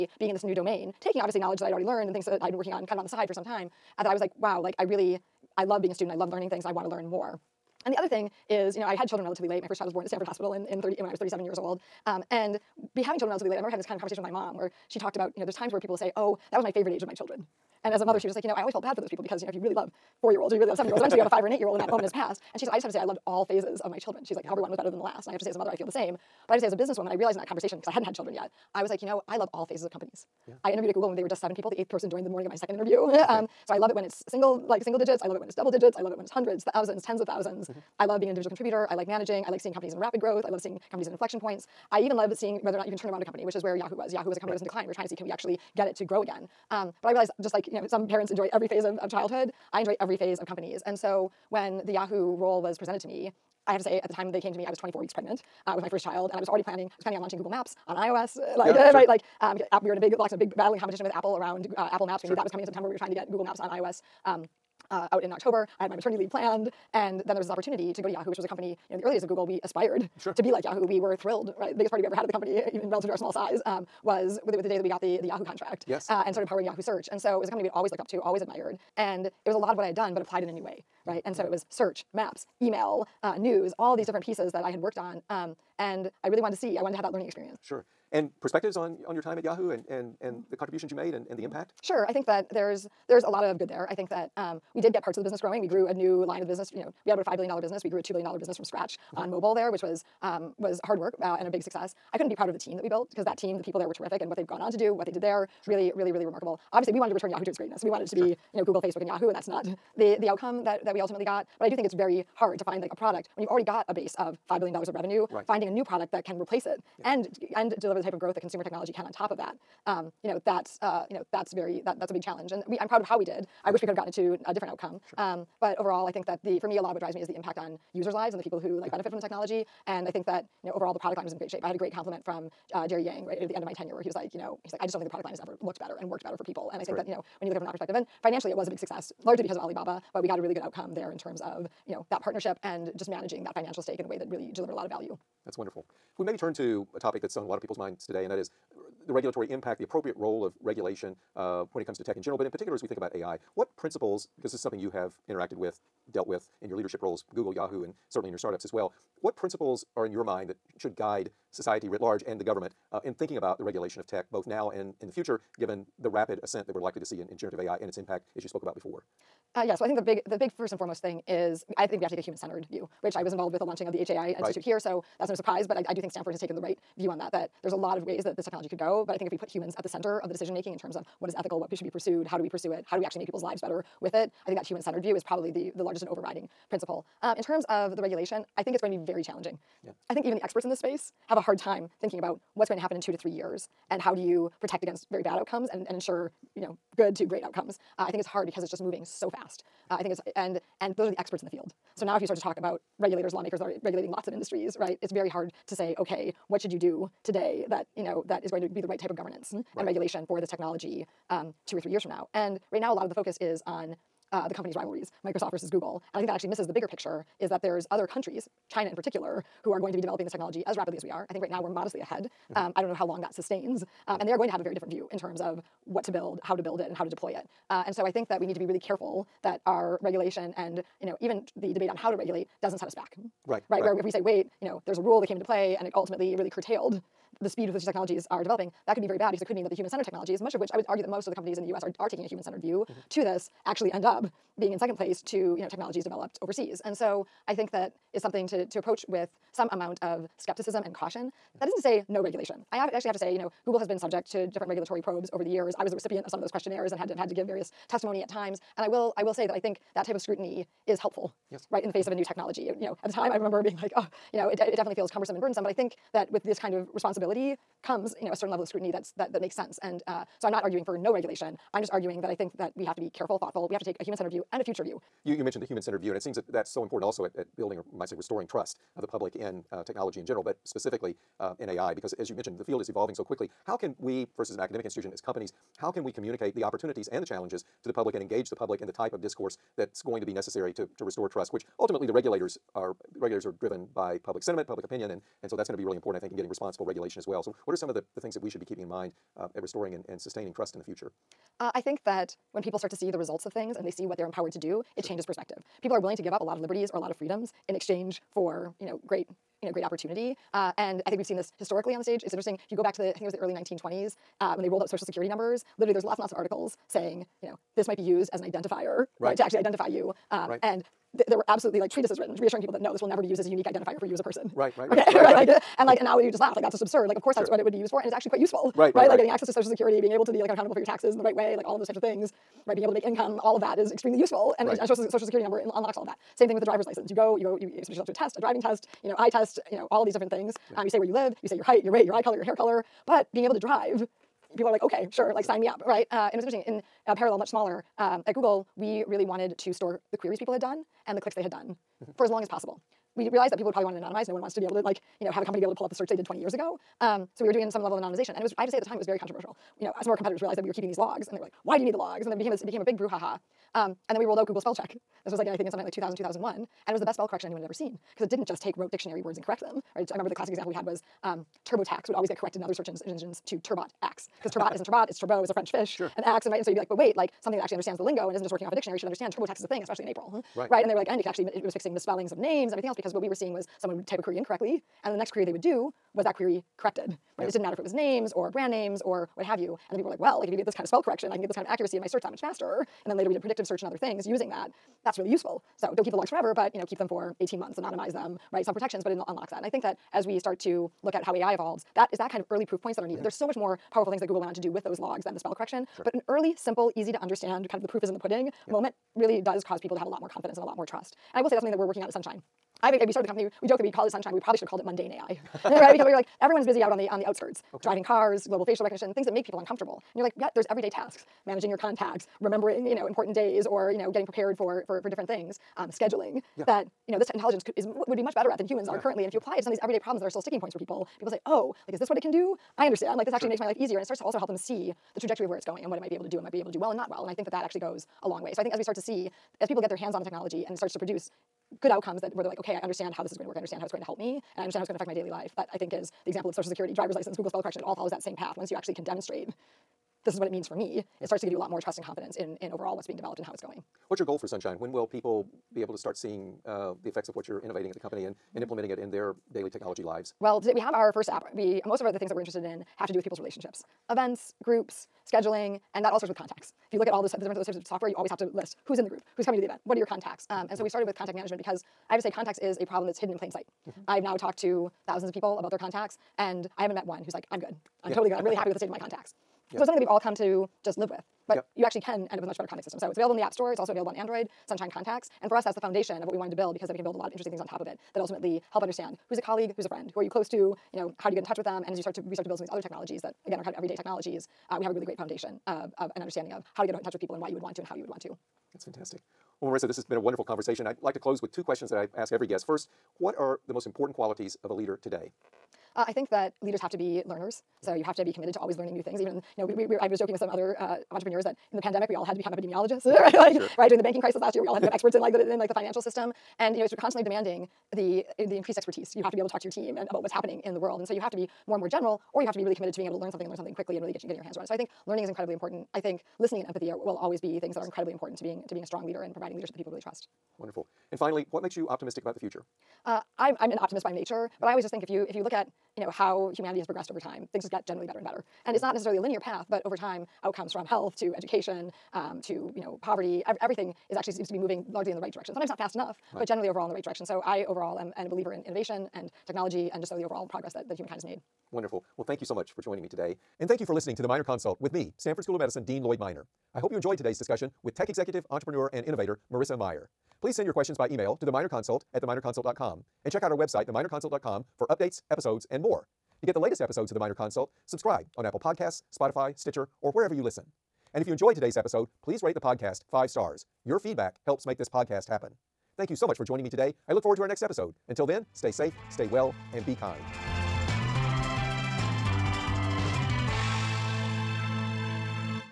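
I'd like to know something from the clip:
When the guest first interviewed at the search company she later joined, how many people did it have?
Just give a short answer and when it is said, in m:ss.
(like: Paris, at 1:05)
7, at 0:31.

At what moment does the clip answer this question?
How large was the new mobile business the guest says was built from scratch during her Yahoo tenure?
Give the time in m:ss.
1:38.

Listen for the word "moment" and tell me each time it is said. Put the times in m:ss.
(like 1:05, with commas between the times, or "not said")
0:21, 6:48.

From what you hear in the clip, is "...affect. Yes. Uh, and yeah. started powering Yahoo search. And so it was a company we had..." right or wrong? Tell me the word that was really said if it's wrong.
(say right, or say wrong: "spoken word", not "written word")
wrong: "contract", not "affect".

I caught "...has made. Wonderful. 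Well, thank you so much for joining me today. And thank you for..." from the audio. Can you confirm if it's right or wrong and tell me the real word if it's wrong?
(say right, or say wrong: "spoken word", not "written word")
right.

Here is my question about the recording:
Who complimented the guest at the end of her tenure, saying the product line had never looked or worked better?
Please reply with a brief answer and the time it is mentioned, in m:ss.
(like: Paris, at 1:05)
Jerry Yang, at 2:12.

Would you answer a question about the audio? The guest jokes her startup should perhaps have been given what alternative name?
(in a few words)
Mundane AI.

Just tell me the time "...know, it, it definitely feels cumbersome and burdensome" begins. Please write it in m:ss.
4:24.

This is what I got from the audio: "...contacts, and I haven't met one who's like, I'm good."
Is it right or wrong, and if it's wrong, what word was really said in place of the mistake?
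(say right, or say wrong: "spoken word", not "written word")
right.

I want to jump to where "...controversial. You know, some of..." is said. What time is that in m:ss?
5:59.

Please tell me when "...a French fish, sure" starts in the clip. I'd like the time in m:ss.
6:15.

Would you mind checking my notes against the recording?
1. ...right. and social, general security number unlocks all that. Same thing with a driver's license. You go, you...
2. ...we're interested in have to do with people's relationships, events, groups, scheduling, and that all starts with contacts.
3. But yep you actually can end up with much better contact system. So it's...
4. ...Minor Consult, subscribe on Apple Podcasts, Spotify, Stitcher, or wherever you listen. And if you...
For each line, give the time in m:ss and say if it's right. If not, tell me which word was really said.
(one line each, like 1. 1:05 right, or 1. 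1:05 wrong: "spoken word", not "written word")
1. 5:34 wrong: "social", not "general"
2. 7:42 right
3. 8:01 right
4. 9:27 right.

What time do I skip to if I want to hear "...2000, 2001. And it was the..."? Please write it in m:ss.
6:05.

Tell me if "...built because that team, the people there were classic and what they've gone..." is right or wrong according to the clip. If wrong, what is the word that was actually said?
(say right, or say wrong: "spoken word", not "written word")
wrong: "terrific", not "classic".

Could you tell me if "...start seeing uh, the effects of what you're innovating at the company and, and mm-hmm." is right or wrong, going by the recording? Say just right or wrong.
right.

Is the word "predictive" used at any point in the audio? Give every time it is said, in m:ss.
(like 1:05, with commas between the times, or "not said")
6:33.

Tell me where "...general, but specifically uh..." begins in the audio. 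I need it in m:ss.
4:40.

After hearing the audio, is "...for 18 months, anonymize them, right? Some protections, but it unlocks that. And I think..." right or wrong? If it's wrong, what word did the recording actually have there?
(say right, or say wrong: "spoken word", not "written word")
right.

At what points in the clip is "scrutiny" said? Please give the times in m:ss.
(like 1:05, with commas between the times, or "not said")
4:20, 4:28.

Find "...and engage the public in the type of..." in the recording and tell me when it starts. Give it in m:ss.
4:48.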